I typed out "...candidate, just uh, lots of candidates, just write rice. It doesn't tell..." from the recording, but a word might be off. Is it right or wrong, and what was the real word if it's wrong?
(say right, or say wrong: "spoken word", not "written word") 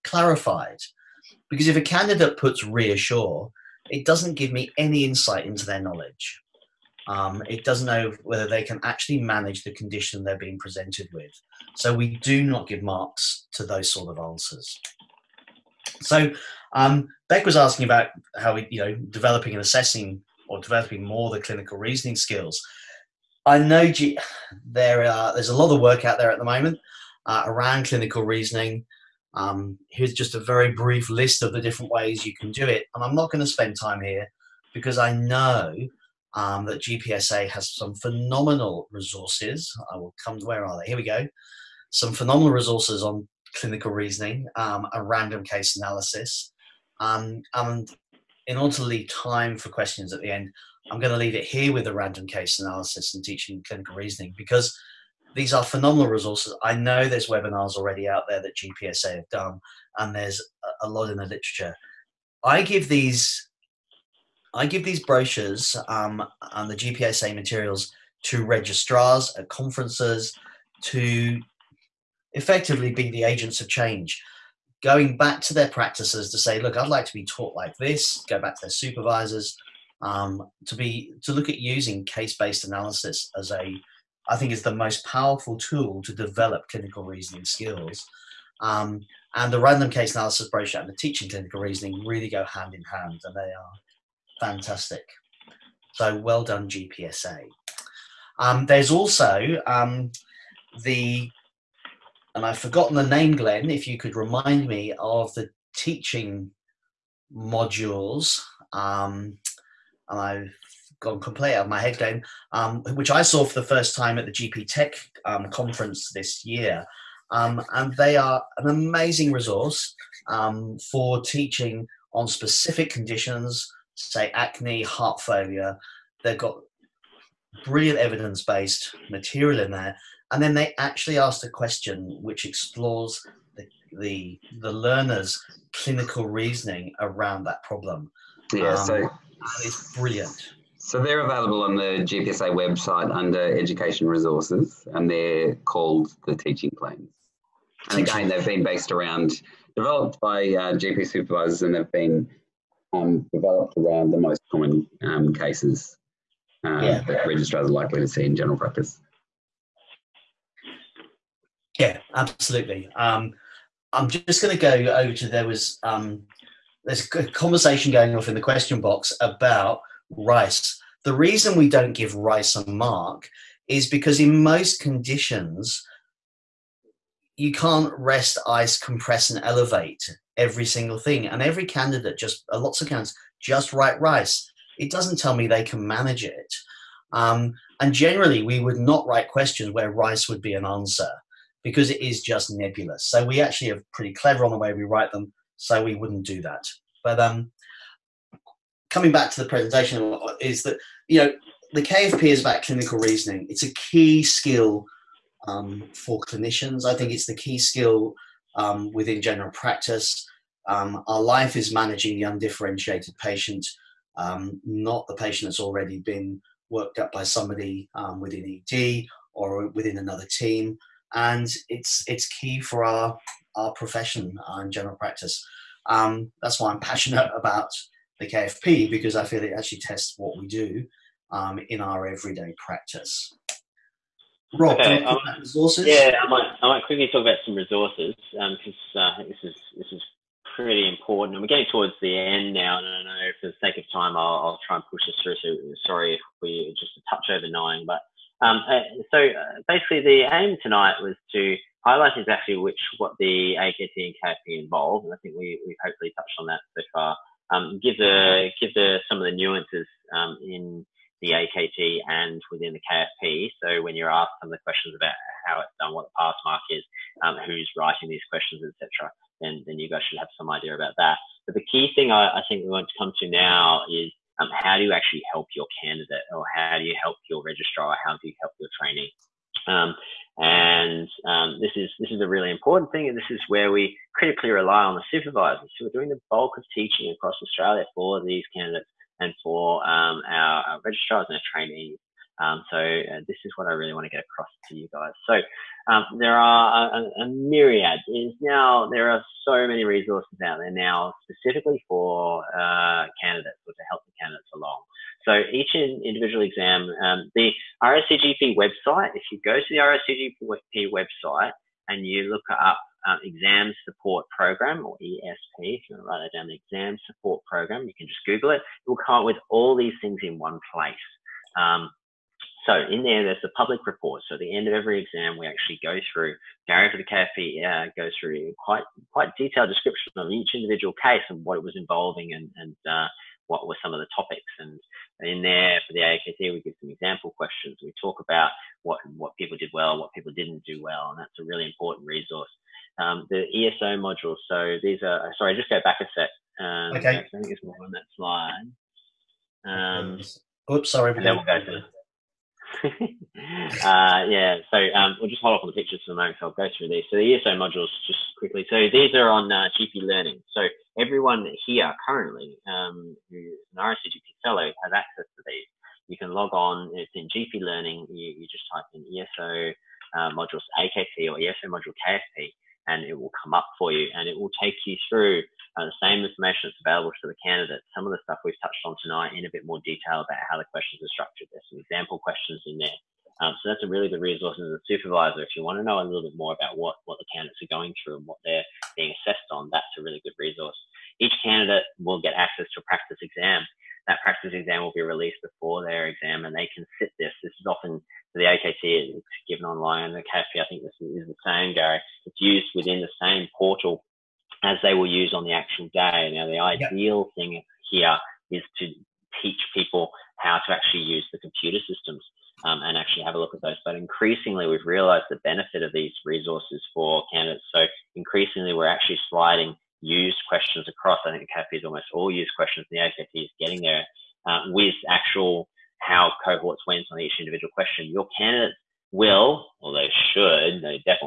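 right.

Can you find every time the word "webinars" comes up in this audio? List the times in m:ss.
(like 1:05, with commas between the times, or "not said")
0:57.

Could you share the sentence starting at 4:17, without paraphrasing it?
Um, give the give the some of the nuances um, in the AKT and within the KFP.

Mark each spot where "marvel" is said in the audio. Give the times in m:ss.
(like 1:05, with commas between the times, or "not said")
not said.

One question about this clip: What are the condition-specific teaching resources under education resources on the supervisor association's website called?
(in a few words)
teaching plans.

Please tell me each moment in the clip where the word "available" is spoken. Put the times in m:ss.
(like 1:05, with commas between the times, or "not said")
2:21, 6:16.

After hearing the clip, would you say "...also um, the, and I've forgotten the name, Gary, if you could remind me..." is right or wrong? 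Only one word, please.
wrong.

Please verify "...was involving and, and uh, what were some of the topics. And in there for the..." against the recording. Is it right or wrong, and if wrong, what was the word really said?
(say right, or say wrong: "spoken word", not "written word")
right.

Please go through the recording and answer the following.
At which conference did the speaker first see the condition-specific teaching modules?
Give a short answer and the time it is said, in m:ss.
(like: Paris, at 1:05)
GPTEC, at 1:54.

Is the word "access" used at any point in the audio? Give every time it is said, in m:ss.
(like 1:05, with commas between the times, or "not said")
6:04, 6:32.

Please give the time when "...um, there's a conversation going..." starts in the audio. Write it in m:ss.
2:45.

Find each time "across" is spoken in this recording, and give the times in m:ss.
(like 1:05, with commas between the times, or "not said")
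4:47, 4:54, 7:00.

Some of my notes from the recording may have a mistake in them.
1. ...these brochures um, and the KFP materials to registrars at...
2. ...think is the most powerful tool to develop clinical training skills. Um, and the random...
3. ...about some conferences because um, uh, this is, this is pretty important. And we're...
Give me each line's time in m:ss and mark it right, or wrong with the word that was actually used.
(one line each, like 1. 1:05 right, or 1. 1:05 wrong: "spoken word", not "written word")
1. 1:04 wrong: "GPSA", not "KFP"
2. 1:24 wrong: "reasoning", not "training"
3. 3:57 wrong: "resources", not "conferences".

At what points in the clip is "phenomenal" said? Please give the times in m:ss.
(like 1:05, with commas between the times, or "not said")
0:37, 0:42, 0:55.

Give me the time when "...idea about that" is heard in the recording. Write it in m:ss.
4:30.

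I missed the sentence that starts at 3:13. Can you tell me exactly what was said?
So we actually are pretty clever on the way we write them.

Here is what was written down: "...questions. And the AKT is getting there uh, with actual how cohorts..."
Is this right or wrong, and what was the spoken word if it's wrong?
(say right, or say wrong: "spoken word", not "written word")
right.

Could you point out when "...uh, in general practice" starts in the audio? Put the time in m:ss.
3:44.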